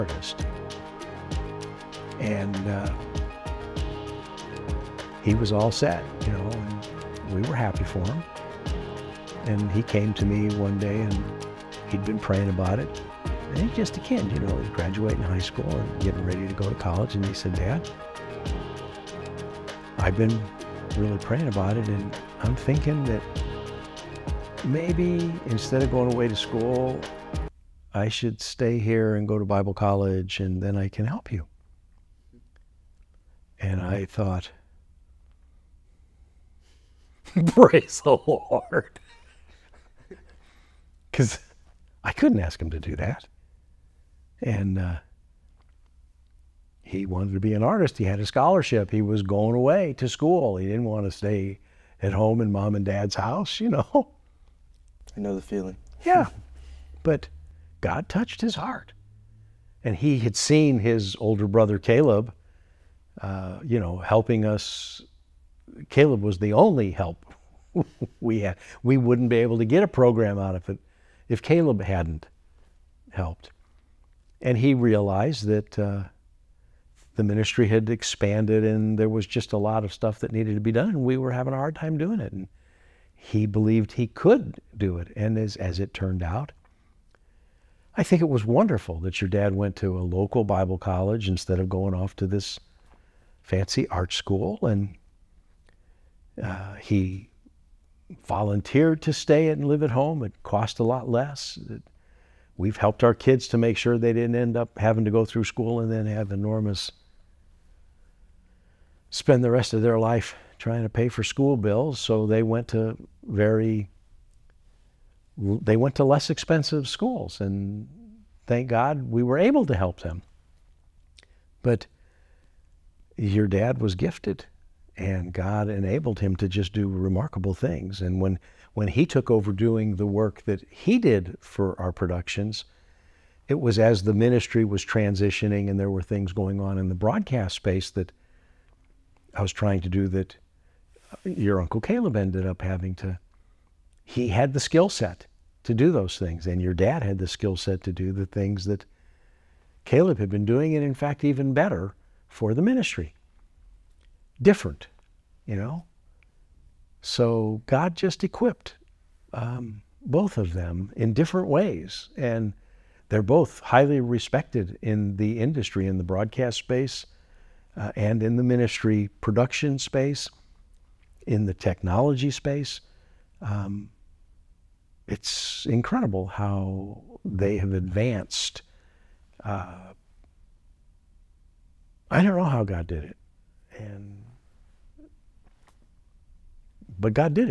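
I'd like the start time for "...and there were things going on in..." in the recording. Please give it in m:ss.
2:15.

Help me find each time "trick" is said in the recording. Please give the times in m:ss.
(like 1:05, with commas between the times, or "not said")
not said.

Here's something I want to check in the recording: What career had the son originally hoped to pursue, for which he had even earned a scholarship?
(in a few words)
Artist.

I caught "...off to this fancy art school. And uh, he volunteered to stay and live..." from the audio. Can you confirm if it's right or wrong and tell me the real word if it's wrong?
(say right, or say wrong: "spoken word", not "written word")
right.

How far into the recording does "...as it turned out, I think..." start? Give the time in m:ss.
1:25.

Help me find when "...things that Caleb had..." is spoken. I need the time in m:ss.
2:28.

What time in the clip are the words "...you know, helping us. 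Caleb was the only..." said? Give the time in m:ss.
1:03.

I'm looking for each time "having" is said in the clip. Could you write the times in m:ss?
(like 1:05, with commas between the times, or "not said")
1:21, 1:44, 2:22.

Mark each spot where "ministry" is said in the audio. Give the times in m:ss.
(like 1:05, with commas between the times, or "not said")
1:17, 2:14, 2:32, 2:48.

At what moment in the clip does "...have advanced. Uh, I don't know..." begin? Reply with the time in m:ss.
2:57.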